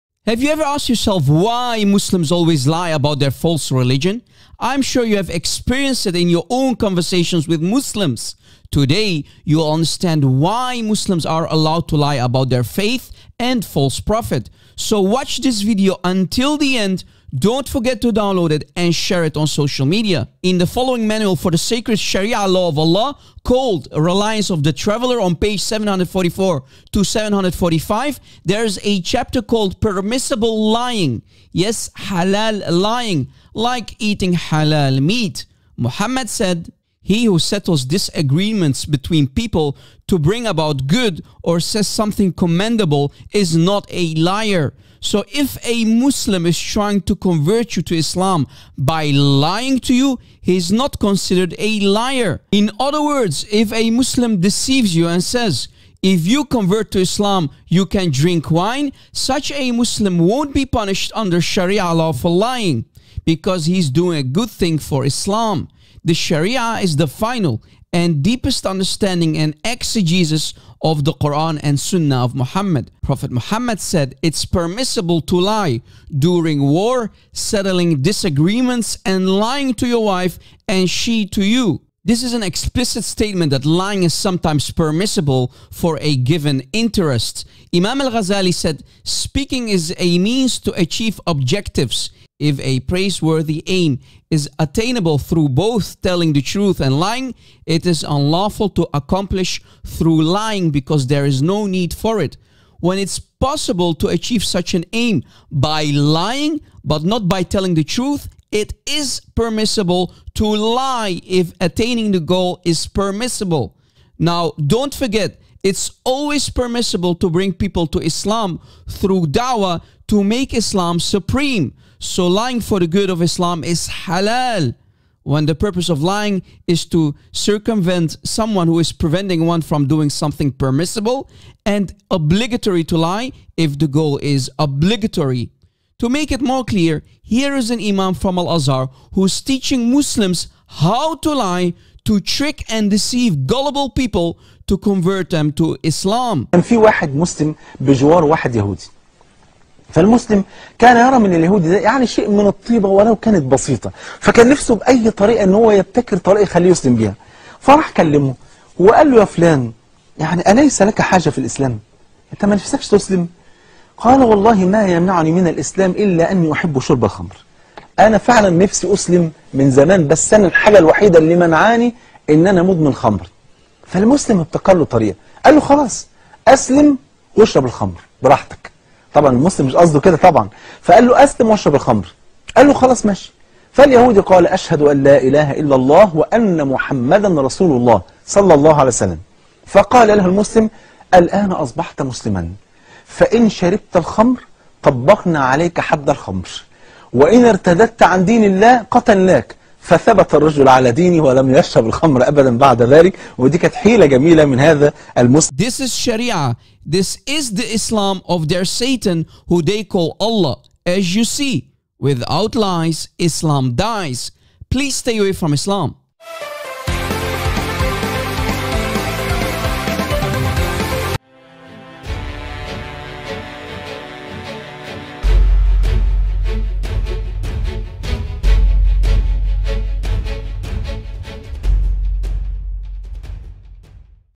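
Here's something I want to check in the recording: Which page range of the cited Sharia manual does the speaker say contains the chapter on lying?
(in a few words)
744 to 745.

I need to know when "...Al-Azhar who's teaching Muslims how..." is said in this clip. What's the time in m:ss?
2:18.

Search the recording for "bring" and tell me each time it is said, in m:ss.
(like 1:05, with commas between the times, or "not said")
0:40, 1:57.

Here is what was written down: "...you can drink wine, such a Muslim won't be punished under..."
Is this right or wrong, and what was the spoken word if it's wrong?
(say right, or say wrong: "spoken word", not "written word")
right.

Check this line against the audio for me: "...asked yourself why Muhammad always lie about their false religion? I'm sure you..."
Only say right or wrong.
wrong.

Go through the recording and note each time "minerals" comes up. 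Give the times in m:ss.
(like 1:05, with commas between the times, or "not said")
not said.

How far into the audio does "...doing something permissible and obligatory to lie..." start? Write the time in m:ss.
2:09.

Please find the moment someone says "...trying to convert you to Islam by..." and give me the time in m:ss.
0:46.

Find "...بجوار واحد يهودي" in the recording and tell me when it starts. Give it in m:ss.
2:27.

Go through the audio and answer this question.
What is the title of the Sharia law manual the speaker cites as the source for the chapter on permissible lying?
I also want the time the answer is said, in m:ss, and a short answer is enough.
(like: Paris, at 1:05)
Reliance of the Traveler, at 0:23.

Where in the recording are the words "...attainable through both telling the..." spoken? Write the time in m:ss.
1:34.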